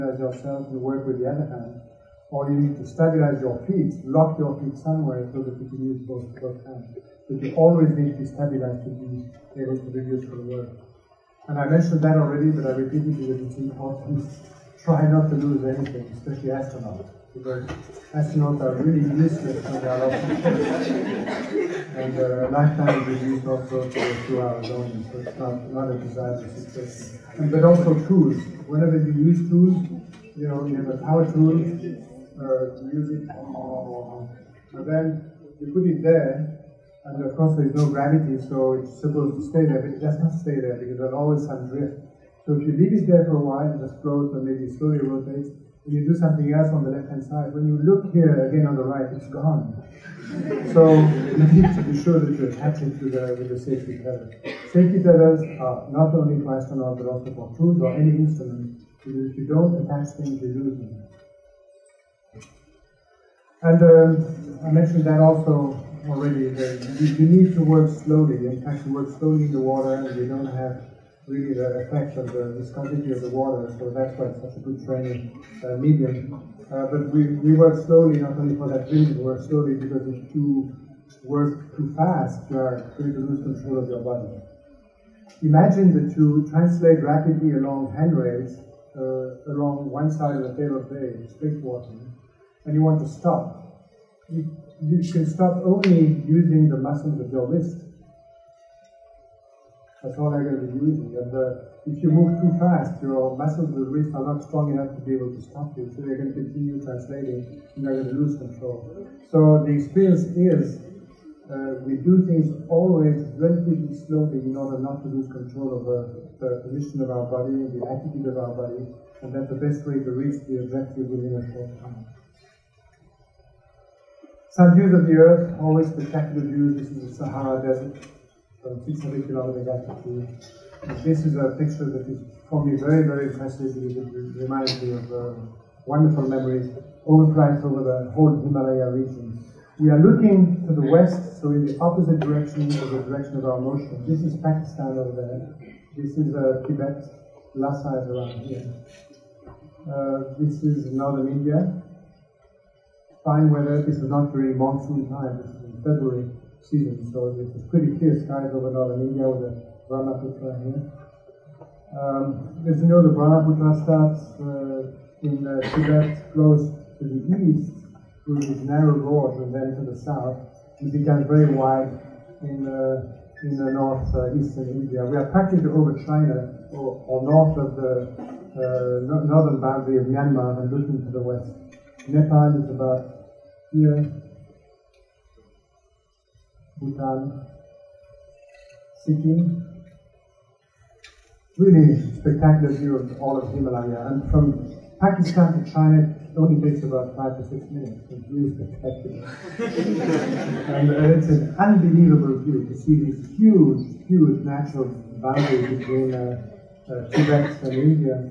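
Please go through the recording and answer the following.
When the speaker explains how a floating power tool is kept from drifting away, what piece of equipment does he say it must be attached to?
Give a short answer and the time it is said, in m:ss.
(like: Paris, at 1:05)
safety tether, at 0:53.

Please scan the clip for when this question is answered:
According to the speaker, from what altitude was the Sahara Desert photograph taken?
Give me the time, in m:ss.
2:08.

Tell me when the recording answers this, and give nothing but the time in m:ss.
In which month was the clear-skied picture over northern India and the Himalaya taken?
2:35.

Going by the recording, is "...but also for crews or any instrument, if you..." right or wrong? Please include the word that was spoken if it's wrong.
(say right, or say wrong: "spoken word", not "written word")
right.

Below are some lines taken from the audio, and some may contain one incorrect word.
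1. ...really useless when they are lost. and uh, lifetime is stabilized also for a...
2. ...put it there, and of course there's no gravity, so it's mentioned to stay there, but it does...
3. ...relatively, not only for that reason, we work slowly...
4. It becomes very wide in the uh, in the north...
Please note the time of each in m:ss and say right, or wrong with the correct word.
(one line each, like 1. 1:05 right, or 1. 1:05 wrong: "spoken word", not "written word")
1. 0:18 wrong: "reduced", not "stabilized"
2. 0:35 wrong: "supposed", not "mentioned"
3. 1:17 wrong: "slowly", not "relatively"
4. 2:50 right.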